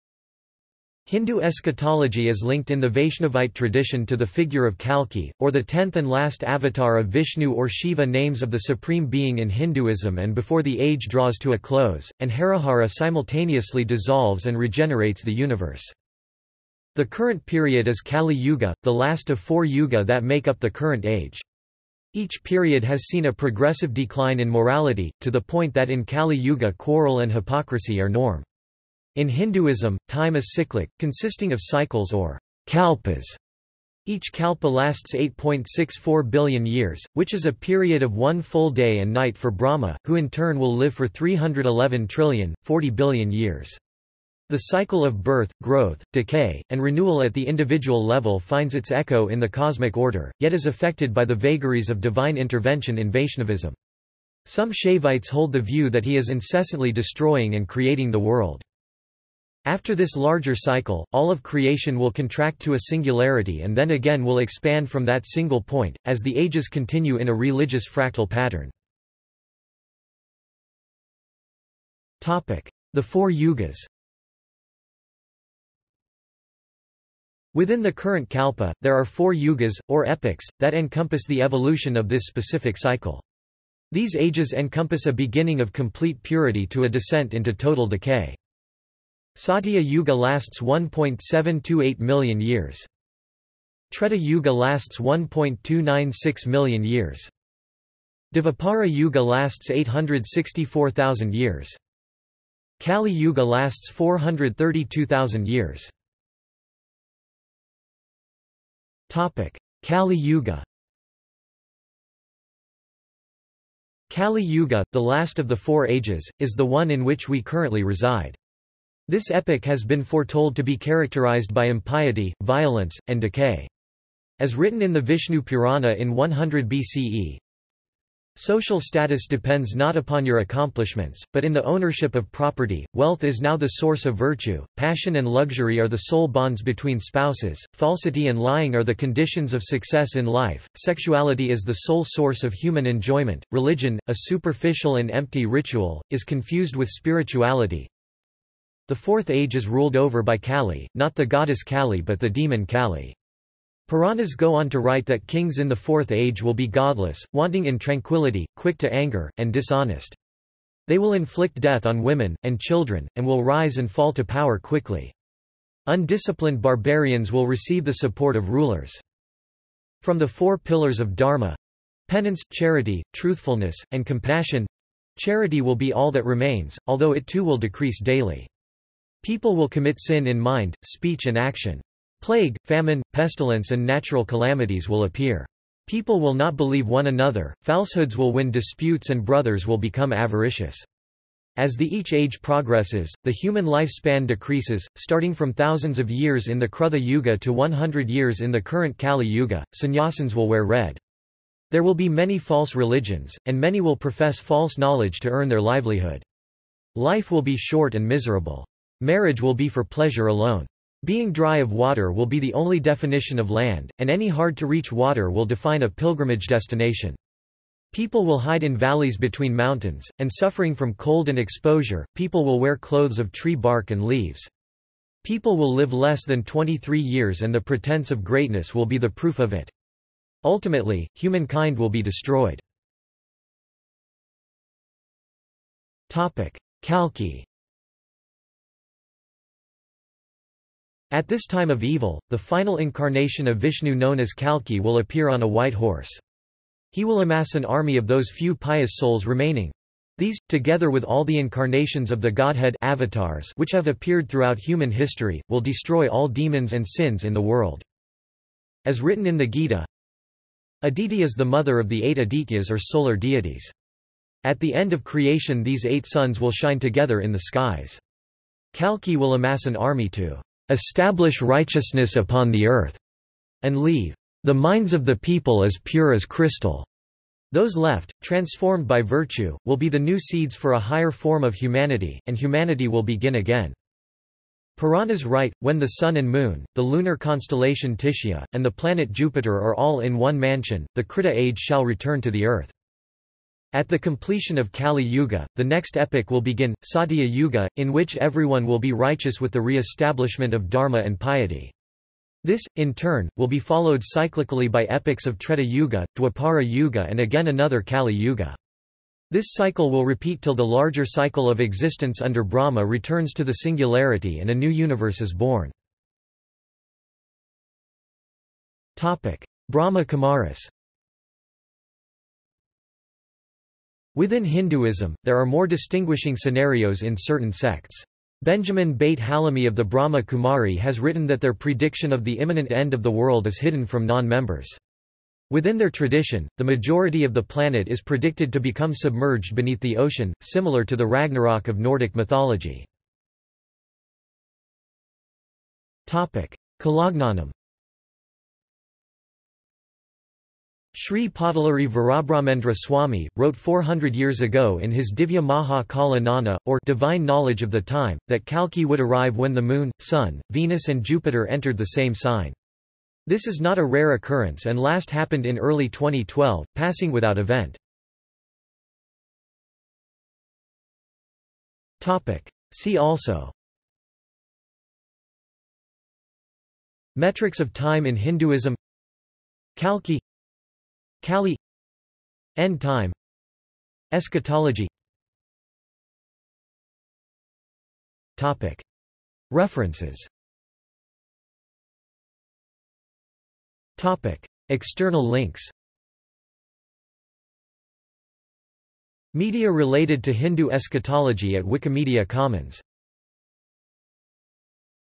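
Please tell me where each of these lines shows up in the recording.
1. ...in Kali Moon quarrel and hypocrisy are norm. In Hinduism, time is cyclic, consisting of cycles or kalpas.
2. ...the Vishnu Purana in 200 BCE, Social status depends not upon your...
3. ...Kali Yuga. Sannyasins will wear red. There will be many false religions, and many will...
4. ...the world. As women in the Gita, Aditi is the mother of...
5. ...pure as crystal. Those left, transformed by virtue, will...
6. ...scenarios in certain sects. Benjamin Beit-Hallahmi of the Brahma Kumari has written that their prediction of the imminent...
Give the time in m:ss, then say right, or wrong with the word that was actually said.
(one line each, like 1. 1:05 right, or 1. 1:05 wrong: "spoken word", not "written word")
1. 0:25 wrong: "Yuga", not "Moon"
2. 2:04 wrong: "100", not "200"
3. 3:18 right
4. 4:17 wrong: "written", not "women"
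5. 4:35 right
6. 5:26 right.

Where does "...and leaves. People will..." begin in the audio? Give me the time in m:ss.
3:43.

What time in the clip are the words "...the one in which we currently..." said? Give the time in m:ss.
1:56.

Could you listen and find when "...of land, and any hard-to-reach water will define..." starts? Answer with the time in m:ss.
3:33.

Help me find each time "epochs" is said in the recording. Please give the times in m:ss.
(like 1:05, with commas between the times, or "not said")
1:20, 1:59, 4:55, 5:04.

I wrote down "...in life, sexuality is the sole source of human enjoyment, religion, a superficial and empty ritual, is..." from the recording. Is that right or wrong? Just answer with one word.
right.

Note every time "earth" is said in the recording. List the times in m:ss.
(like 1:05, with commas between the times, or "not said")
4:32, 4:52.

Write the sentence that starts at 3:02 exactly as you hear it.
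Plague, famine, pestilence and natural calamities will appear.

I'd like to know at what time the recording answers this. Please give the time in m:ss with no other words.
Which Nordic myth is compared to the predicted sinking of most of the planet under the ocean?
5:41.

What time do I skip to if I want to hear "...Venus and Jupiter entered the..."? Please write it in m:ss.
6:00.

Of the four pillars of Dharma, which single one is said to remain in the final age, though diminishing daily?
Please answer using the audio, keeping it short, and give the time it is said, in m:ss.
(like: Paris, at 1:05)
Charity, at 2:52.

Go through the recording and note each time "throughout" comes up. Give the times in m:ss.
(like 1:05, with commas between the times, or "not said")
4:14.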